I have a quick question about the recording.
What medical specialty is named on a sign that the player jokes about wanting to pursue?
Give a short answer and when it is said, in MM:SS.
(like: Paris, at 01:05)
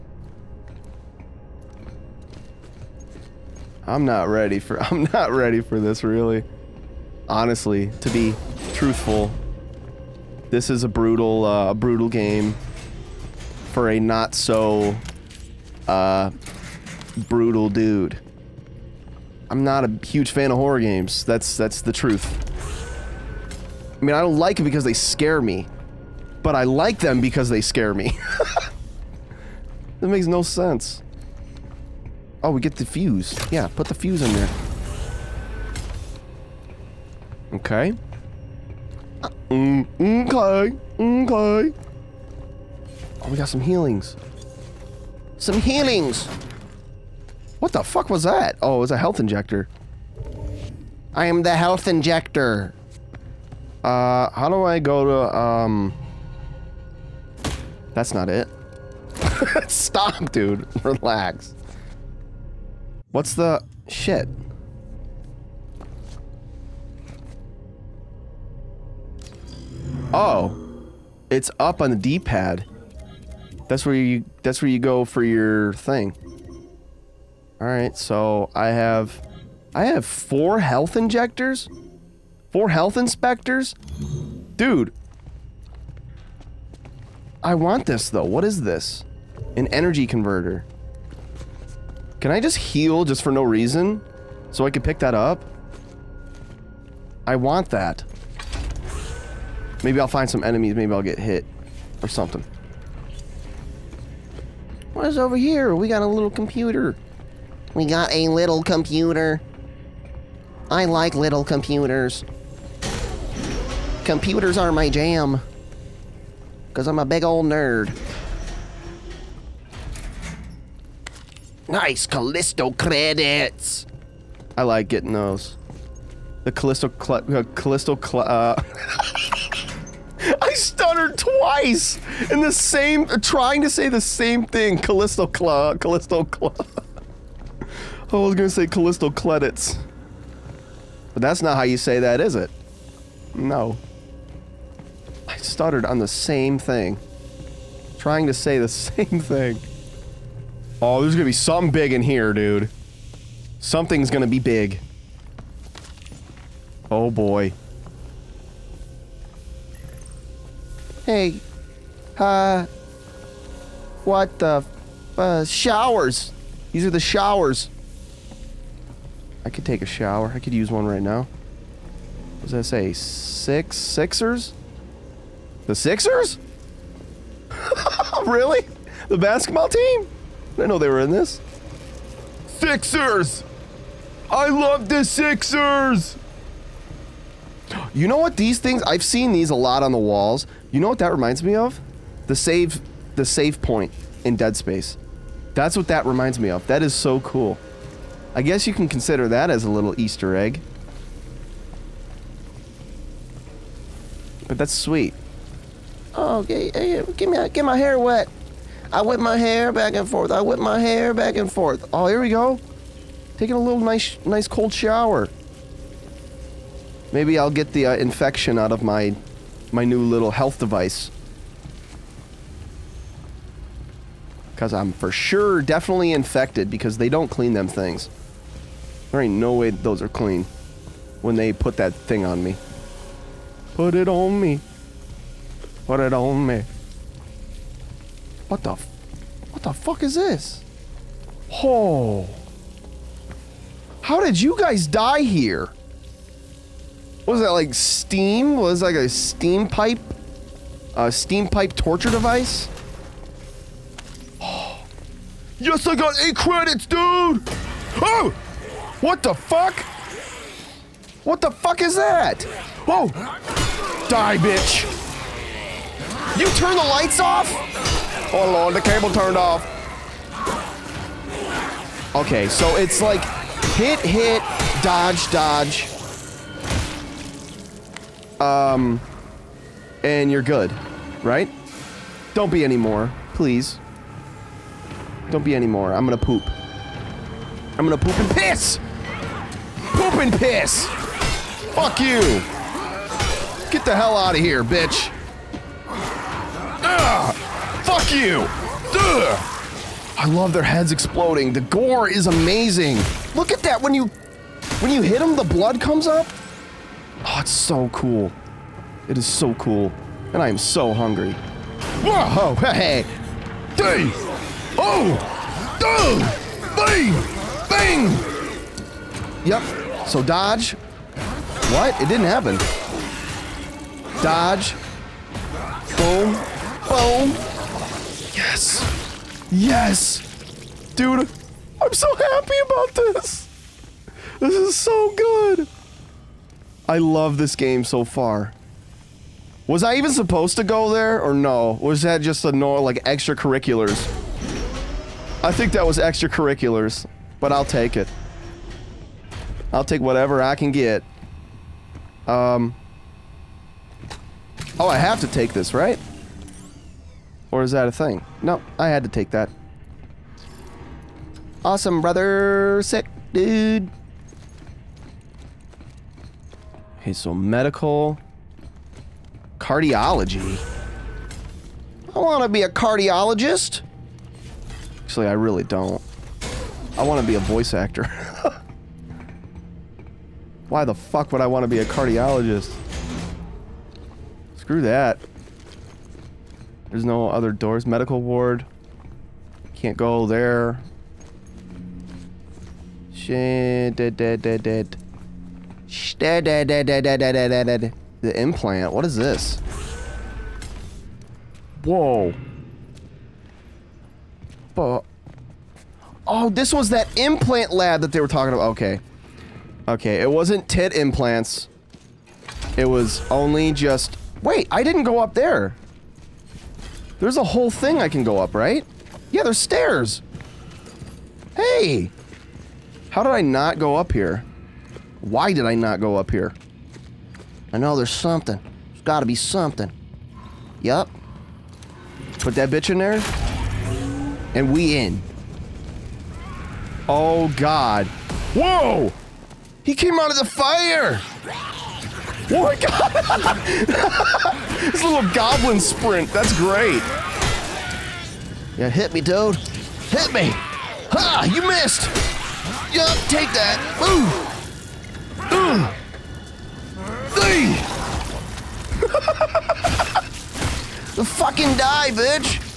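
Cardiology, at 06:09.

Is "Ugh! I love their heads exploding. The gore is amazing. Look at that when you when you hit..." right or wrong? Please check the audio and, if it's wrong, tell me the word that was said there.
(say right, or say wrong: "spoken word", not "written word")
right.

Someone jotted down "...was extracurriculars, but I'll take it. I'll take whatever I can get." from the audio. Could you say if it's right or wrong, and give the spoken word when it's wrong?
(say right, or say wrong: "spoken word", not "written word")
right.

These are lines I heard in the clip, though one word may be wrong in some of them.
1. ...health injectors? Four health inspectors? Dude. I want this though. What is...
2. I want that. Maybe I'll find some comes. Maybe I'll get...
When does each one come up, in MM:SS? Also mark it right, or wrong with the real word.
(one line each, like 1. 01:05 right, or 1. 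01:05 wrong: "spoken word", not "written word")
1. 01:20 right
2. 01:37 wrong: "enemies", not "comes".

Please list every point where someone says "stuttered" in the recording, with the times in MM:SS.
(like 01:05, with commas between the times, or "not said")
02:10, 02:25.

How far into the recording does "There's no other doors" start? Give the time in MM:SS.
06:26.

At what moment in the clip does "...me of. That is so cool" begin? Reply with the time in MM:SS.
03:16.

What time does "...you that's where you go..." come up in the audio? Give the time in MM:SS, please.
01:13.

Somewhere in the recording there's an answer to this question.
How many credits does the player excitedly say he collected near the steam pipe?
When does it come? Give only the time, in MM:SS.
04:16.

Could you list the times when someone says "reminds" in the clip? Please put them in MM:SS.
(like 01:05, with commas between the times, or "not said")
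03:11, 03:16.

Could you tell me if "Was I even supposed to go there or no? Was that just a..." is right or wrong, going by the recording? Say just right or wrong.
right.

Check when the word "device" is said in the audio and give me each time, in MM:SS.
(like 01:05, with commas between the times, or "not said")
03:40, 04:12.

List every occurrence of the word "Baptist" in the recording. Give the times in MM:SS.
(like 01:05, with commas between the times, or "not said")
not said.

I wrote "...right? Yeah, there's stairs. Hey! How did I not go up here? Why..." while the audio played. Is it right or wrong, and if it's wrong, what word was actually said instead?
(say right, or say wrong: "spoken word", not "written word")
right.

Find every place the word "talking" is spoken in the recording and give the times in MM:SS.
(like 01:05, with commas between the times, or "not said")
06:48.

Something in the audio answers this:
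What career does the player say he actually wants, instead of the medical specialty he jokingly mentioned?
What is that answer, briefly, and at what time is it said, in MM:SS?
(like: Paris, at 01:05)
Voice actor, at 06:17.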